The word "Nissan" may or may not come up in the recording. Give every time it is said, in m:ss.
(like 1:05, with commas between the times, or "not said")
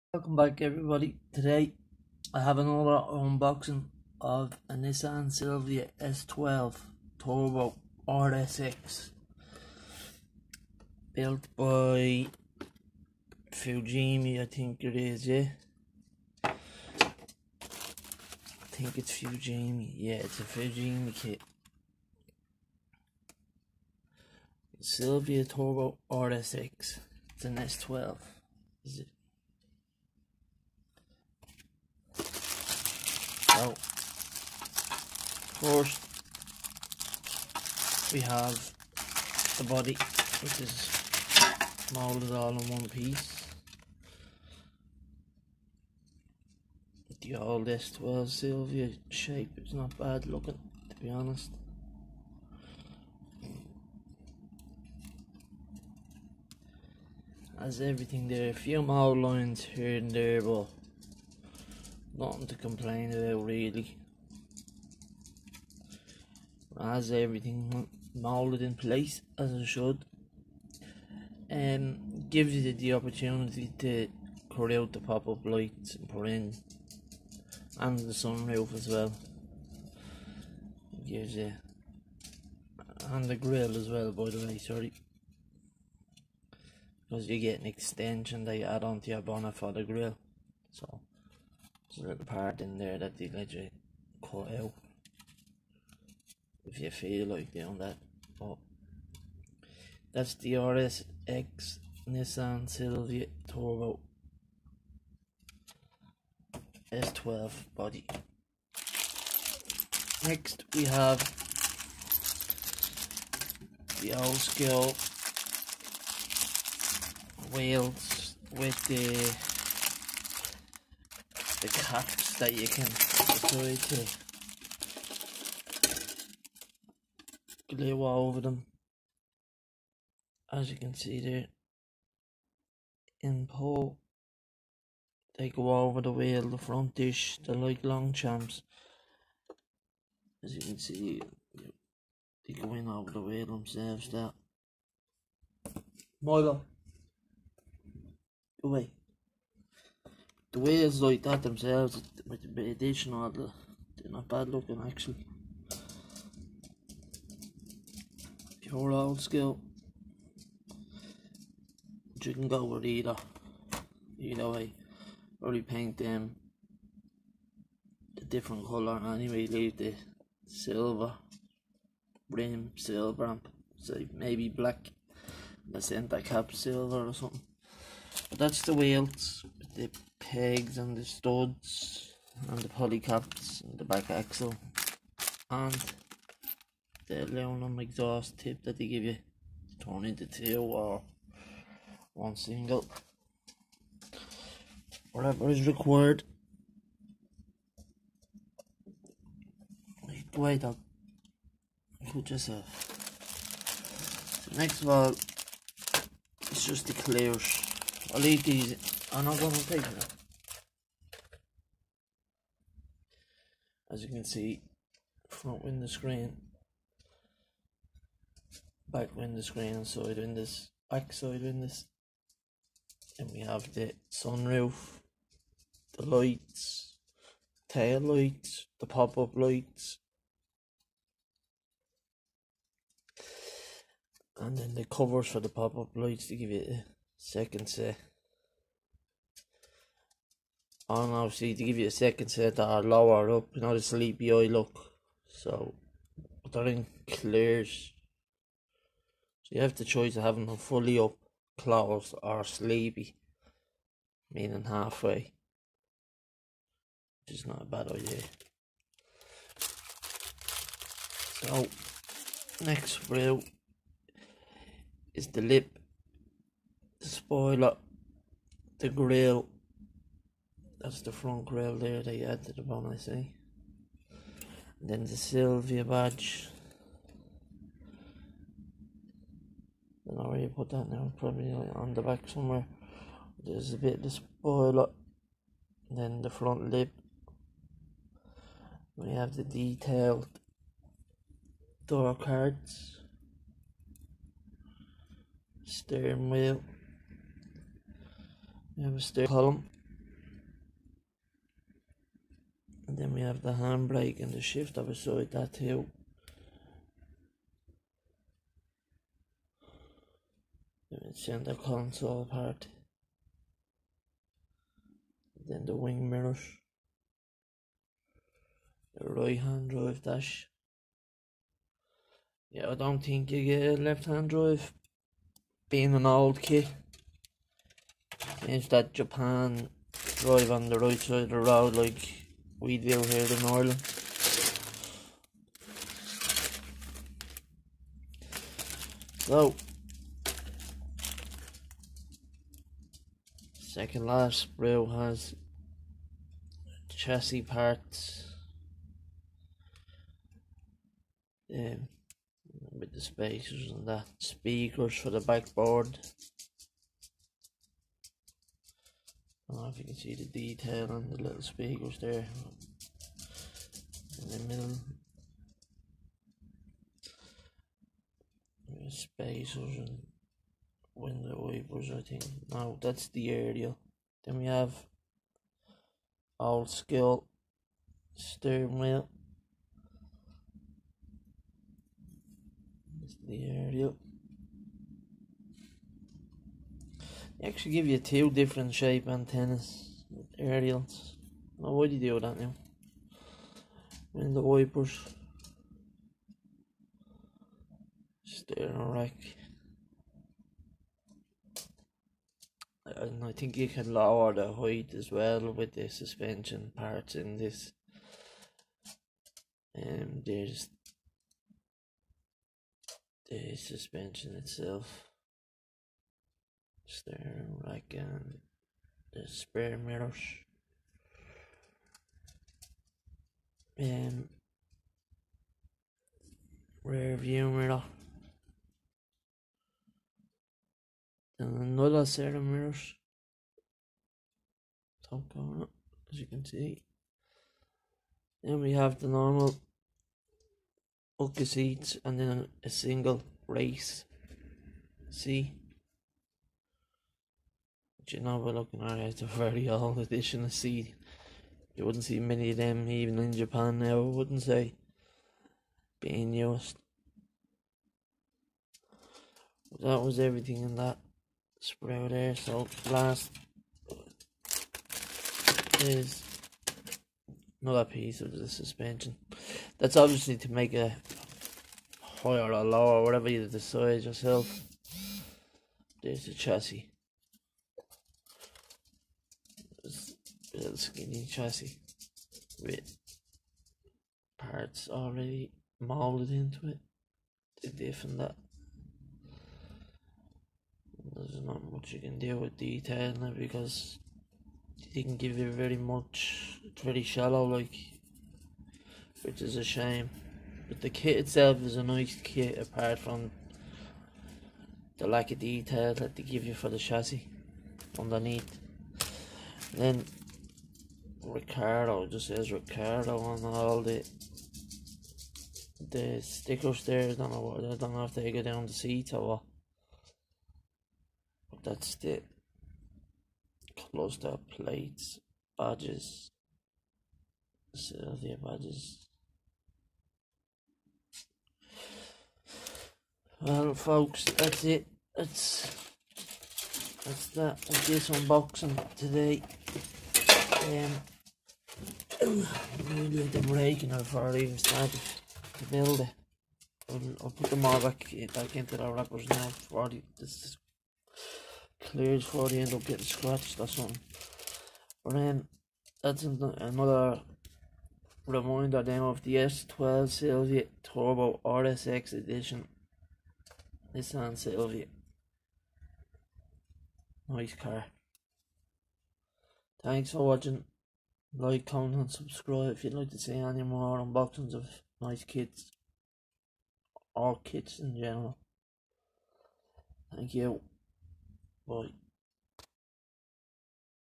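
0:04, 1:42, 9:23.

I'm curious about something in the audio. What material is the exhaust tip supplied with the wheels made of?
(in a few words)
Aluminum.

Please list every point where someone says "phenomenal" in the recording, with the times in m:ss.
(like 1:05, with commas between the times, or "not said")
not said.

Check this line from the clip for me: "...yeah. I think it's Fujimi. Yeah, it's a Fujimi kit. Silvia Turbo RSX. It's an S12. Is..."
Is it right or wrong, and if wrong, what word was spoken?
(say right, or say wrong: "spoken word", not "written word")
right.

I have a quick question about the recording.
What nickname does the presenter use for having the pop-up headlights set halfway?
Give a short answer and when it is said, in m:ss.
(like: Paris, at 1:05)
Sleepy eye look, at 4:03.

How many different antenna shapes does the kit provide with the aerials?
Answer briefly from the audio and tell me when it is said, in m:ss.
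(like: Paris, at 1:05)
2, at 6:27.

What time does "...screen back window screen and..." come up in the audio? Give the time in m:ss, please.
3:35.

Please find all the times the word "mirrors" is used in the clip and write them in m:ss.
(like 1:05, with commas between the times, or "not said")
5:16, 6:59, 7:07, 7:12.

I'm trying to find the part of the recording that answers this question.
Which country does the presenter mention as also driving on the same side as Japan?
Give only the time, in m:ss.
5:33.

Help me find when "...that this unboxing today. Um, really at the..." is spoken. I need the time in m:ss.
8:57.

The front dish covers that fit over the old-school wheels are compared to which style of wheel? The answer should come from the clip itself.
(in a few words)
Longchamps.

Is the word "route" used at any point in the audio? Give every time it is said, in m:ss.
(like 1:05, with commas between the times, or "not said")
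4:23.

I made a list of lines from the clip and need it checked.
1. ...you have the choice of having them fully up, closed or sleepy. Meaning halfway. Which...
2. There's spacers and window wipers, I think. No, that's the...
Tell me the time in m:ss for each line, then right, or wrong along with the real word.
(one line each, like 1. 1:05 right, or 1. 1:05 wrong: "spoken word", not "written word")
1. 4:09 right
2. 6:08 right.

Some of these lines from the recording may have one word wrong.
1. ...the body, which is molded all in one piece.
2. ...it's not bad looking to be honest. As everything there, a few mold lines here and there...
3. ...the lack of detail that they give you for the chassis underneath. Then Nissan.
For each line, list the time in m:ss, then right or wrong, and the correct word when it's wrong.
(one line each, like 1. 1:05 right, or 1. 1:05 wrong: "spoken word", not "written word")
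1. 0:39 right
2. 0:49 right
3. 8:24 wrong: "Ricardo", not "Nissan".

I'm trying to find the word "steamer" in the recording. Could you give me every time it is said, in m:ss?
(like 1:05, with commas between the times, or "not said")
not said.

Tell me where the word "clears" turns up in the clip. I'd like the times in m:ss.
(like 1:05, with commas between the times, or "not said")
3:26, 4:07, 9:11.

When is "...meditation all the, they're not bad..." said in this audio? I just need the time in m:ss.
2:32.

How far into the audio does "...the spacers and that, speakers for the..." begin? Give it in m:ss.
5:52.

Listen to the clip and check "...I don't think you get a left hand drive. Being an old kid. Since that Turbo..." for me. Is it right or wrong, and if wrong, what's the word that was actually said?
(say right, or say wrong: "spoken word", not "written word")
wrong: "Japan", not "Turbo".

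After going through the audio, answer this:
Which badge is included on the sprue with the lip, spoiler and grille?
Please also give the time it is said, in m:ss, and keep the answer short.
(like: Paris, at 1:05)
Silvia badge, at 4:35.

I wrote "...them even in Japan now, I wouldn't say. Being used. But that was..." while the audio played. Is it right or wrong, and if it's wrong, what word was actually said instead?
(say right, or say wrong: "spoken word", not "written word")
right.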